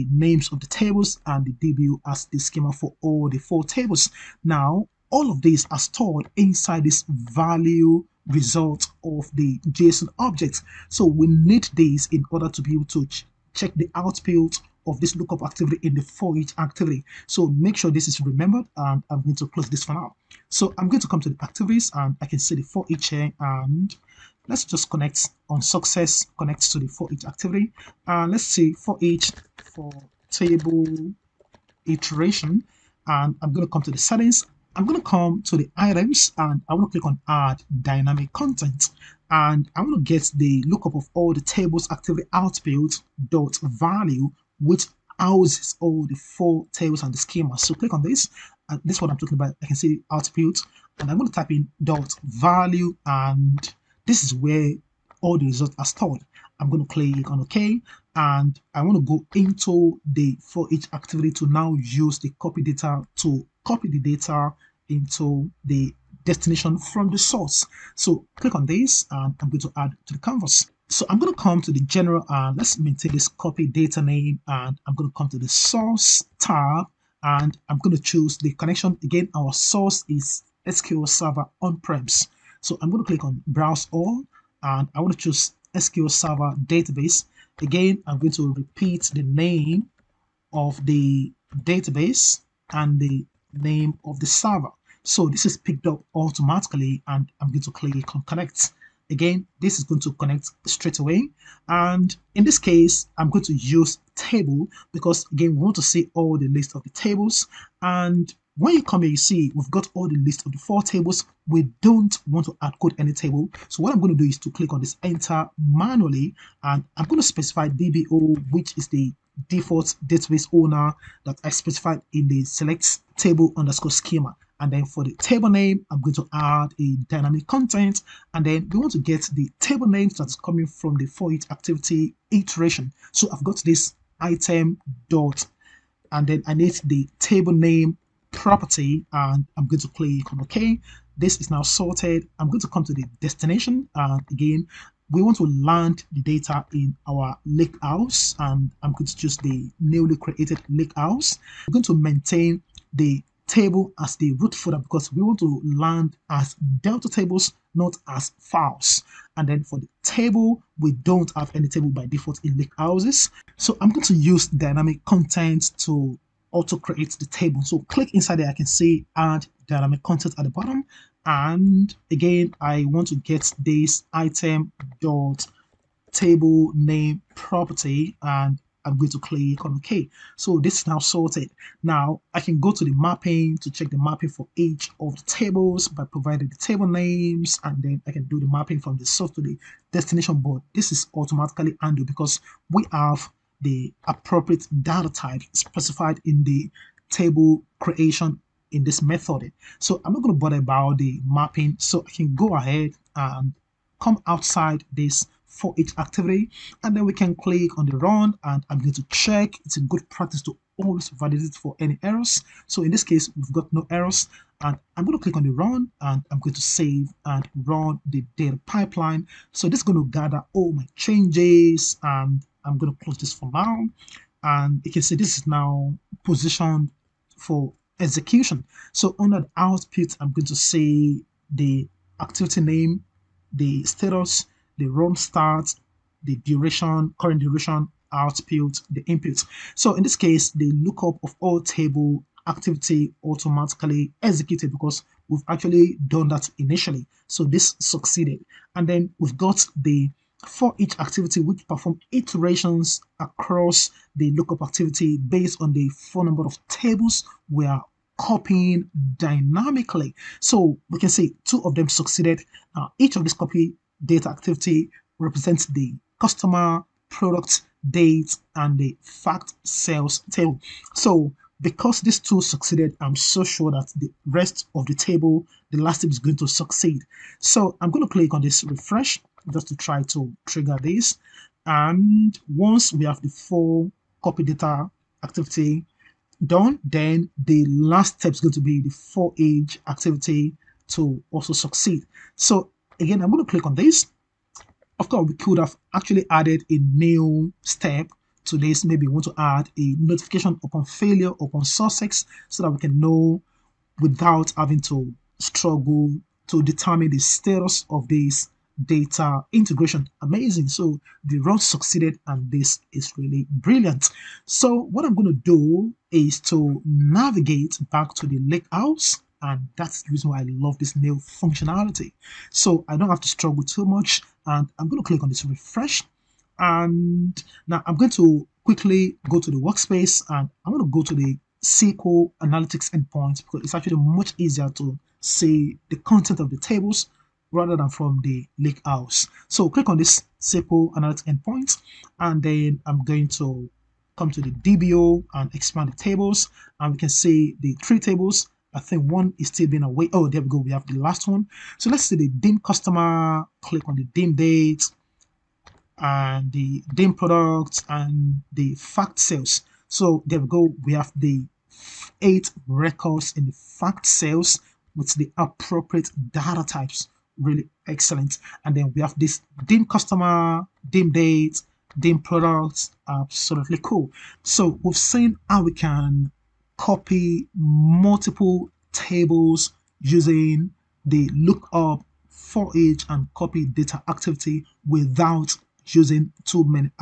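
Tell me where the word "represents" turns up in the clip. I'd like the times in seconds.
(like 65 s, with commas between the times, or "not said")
265 s.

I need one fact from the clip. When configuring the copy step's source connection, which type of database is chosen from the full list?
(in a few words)
SQL Server database.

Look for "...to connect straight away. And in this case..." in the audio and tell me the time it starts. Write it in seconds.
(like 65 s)
100 s.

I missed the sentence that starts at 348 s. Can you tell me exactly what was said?
I think one is still being away.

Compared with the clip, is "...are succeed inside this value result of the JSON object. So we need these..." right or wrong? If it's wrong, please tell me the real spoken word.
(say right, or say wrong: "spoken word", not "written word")
wrong: "stored", not "succeed".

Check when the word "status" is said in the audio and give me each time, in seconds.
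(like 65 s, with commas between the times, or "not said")
233 s, 307 s.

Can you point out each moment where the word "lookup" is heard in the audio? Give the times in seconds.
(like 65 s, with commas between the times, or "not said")
15 s, 40 s, 240 s, 254 s, 381 s.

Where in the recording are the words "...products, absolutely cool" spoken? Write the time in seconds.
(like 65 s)
372 s.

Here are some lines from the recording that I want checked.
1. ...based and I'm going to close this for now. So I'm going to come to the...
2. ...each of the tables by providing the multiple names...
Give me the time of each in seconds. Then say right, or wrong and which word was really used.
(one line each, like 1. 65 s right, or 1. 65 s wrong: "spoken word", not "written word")
1. 18 s wrong: "remembered", not "based"
2. 184 s wrong: "table", not "multiple".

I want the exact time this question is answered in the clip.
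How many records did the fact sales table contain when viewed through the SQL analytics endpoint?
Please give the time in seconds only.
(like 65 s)
362 s.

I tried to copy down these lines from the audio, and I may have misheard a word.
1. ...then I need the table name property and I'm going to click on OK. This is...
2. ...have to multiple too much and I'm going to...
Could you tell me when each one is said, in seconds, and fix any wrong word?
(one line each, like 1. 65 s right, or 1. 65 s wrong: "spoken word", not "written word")
1. 136 s right
2. 323 s wrong: "struggle", not "multiple".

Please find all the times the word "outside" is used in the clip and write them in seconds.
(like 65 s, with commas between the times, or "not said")
204 s.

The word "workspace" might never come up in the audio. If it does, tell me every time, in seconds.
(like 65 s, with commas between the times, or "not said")
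329 s.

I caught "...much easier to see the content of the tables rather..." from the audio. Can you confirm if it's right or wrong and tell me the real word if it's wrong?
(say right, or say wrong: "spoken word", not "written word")
right.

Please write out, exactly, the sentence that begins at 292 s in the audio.
So again, I'm going to click on this.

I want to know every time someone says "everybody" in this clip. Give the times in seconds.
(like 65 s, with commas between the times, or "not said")
not said.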